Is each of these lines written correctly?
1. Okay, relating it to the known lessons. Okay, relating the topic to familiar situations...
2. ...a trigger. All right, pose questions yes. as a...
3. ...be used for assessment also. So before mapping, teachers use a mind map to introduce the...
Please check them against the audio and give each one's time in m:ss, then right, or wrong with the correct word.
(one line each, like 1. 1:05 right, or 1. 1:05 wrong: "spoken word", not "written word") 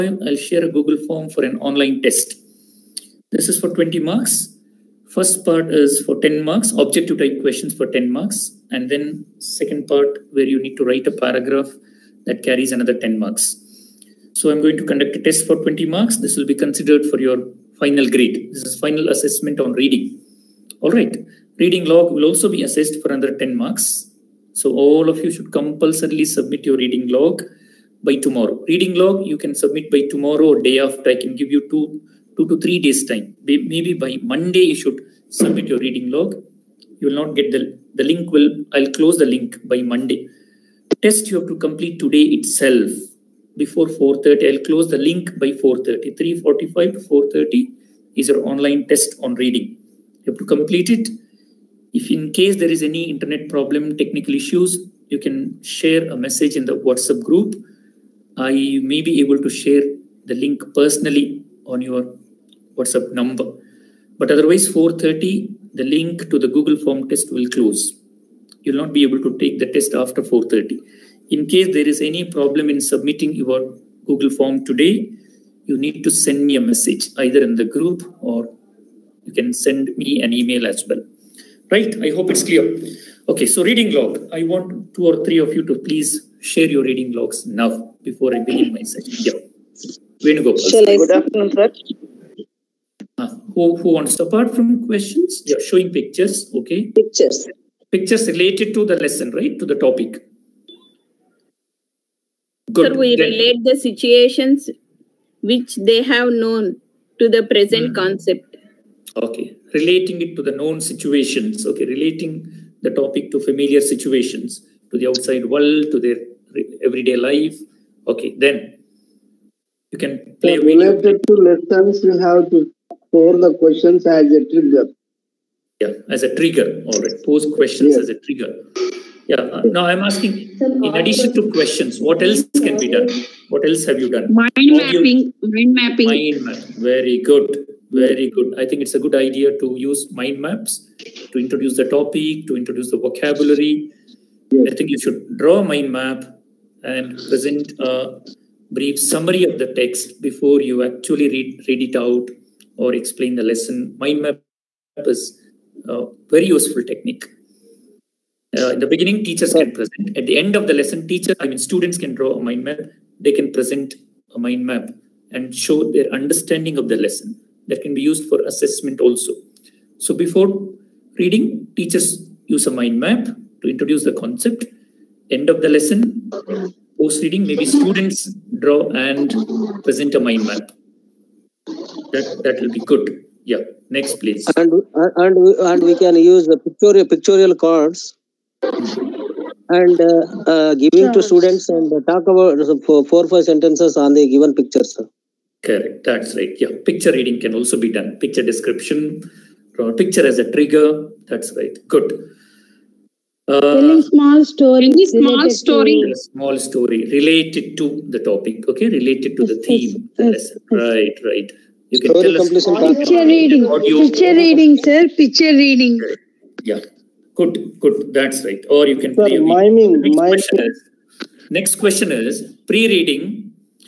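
1. 1:49 wrong: "situations", not "lessons"
2. 2:06 right
3. 2:47 wrong: "reading", not "mapping".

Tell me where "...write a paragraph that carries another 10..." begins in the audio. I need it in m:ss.
0:10.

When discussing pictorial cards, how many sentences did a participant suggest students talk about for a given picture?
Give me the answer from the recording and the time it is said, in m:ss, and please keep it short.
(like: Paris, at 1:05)
4 or 5, at 3:12.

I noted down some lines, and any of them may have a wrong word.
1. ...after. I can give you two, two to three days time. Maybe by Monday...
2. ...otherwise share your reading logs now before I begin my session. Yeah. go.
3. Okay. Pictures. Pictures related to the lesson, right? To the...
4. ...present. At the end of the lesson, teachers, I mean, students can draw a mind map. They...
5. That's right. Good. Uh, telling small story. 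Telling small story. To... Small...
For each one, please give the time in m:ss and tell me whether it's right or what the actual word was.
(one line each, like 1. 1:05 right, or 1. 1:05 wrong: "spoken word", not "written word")
1. 0:30 right
2. 1:25 wrong: "please", not "otherwise"
3. 1:36 right
4. 2:39 right
5. 3:21 right.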